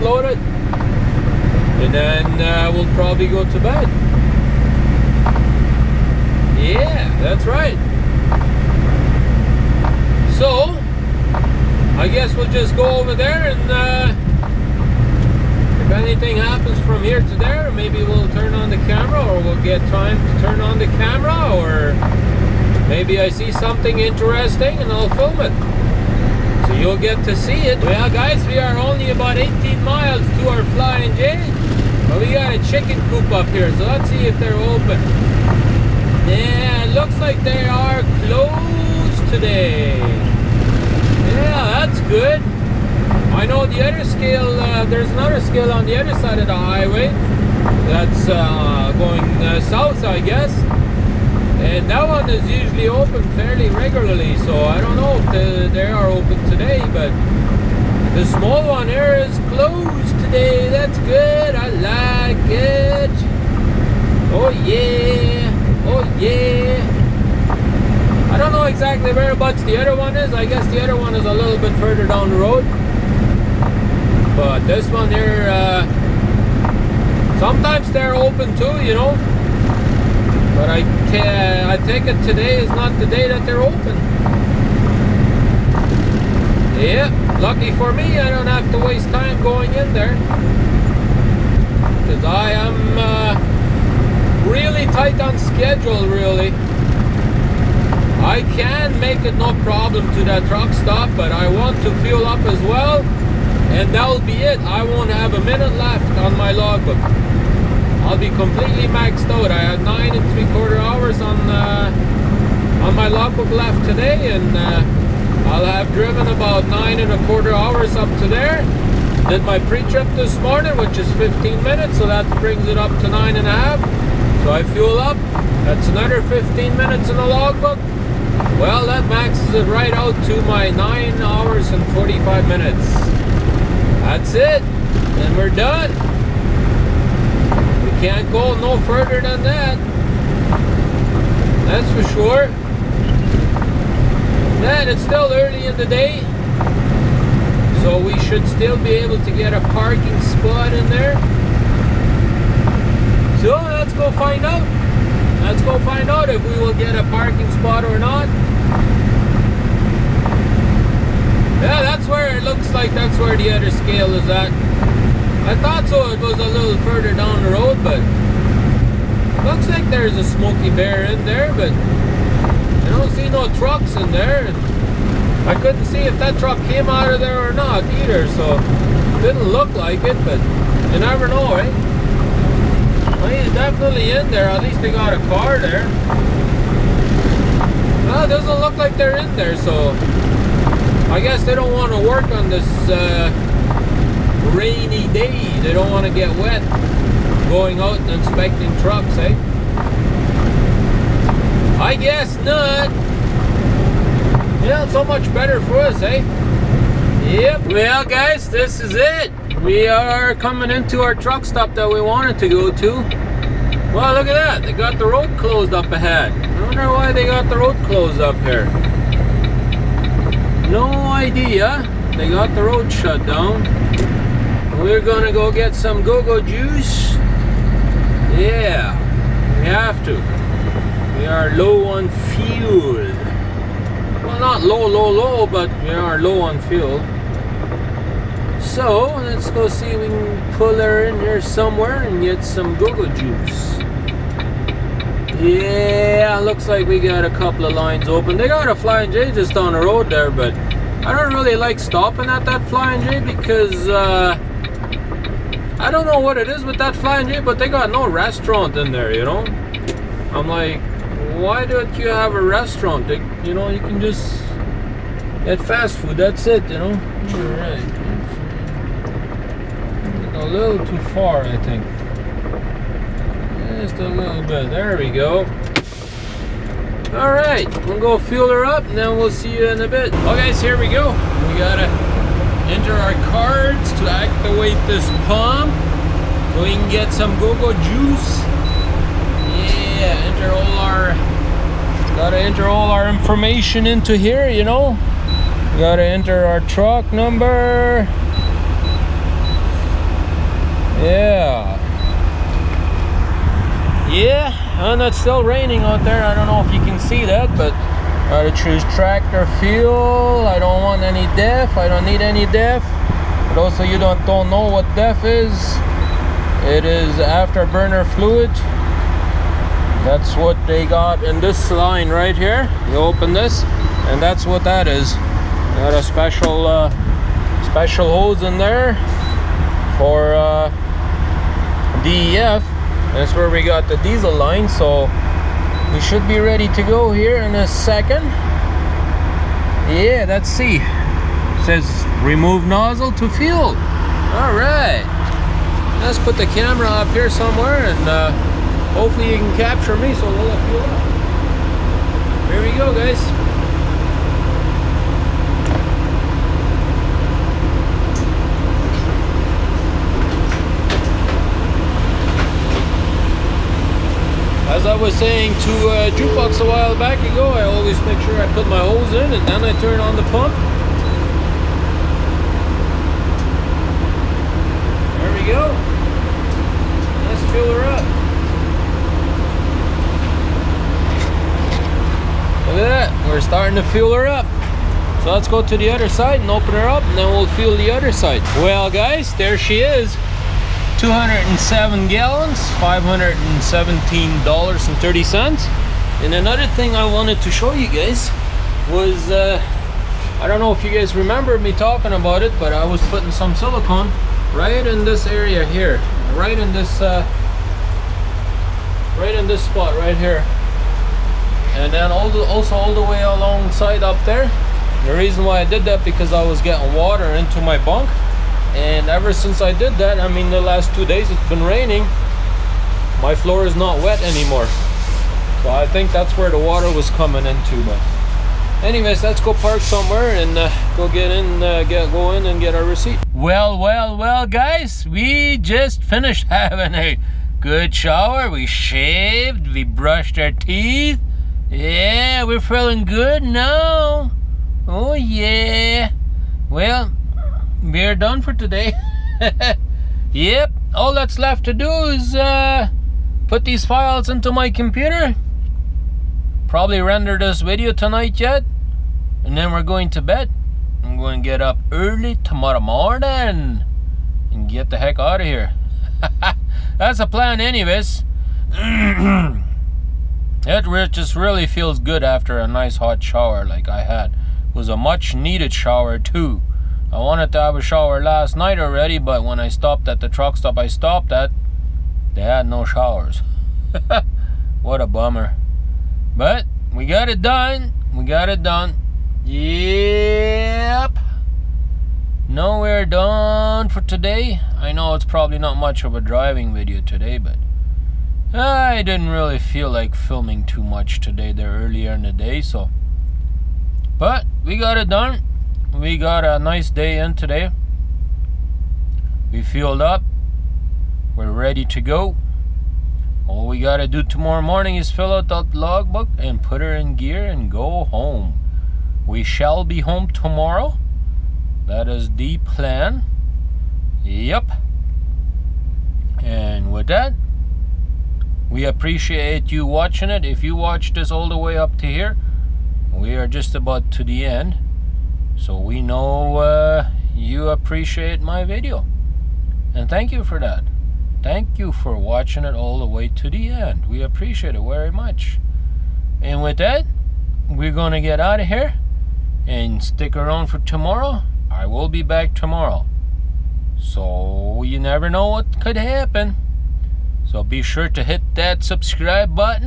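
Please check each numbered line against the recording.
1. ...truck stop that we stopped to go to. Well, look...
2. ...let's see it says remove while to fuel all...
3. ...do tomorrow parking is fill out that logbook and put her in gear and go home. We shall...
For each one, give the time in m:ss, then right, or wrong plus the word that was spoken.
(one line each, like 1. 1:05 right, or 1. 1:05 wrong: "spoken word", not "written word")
1. 3:31 wrong: "wanted", not "stopped"
2. 5:40 wrong: "nozzle", not "while"
3. 8:34 wrong: "morning", not "parking".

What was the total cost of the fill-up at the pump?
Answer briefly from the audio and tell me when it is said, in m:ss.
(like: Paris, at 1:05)
$517.30, at 6:32.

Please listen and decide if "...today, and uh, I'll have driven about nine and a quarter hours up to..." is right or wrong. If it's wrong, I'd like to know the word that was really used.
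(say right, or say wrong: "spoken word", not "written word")
right.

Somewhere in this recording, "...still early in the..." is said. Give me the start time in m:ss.
2:25.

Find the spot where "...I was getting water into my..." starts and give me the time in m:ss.
6:56.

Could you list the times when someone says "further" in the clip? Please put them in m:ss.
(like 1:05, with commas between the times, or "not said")
1:11, 2:18, 2:46.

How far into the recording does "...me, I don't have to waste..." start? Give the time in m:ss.
1:27.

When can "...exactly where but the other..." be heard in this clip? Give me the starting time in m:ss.
1:08.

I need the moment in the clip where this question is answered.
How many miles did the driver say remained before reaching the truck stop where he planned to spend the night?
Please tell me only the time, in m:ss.
0:29.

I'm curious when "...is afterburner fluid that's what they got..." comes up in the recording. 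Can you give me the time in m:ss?
5:16.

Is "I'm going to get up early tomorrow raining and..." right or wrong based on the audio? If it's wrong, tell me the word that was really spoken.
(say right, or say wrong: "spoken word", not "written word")
wrong: "morning", not "raining".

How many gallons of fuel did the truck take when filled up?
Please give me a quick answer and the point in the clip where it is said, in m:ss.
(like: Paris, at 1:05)
207, at 6:30.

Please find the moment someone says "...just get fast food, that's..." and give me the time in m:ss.
4:23.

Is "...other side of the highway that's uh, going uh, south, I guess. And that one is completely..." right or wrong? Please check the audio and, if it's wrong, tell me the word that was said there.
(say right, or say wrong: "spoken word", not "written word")
wrong: "usually", not "completely".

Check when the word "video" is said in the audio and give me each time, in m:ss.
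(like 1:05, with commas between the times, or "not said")
7:37, 8:16, 8:58.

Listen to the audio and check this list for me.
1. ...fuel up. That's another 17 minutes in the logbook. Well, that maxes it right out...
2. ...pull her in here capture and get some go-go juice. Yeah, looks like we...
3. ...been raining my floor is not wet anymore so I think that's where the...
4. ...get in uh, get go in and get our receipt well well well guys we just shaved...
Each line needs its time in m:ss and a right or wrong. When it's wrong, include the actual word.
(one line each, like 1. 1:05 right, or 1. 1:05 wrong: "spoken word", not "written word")
1. 2:04 wrong: "15", not "17"
2. 4:00 wrong: "somewhere", not "capture"
3. 7:01 right
4. 7:11 wrong: "finished", not "shaved".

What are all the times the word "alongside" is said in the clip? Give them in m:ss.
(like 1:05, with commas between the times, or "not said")
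6:53.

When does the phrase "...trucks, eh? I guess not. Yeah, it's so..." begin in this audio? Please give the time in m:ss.
3:18.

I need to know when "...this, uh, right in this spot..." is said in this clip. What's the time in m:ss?
6:46.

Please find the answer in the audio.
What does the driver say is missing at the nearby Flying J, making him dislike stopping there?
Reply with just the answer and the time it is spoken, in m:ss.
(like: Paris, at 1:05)
a restaurant, at 4:17.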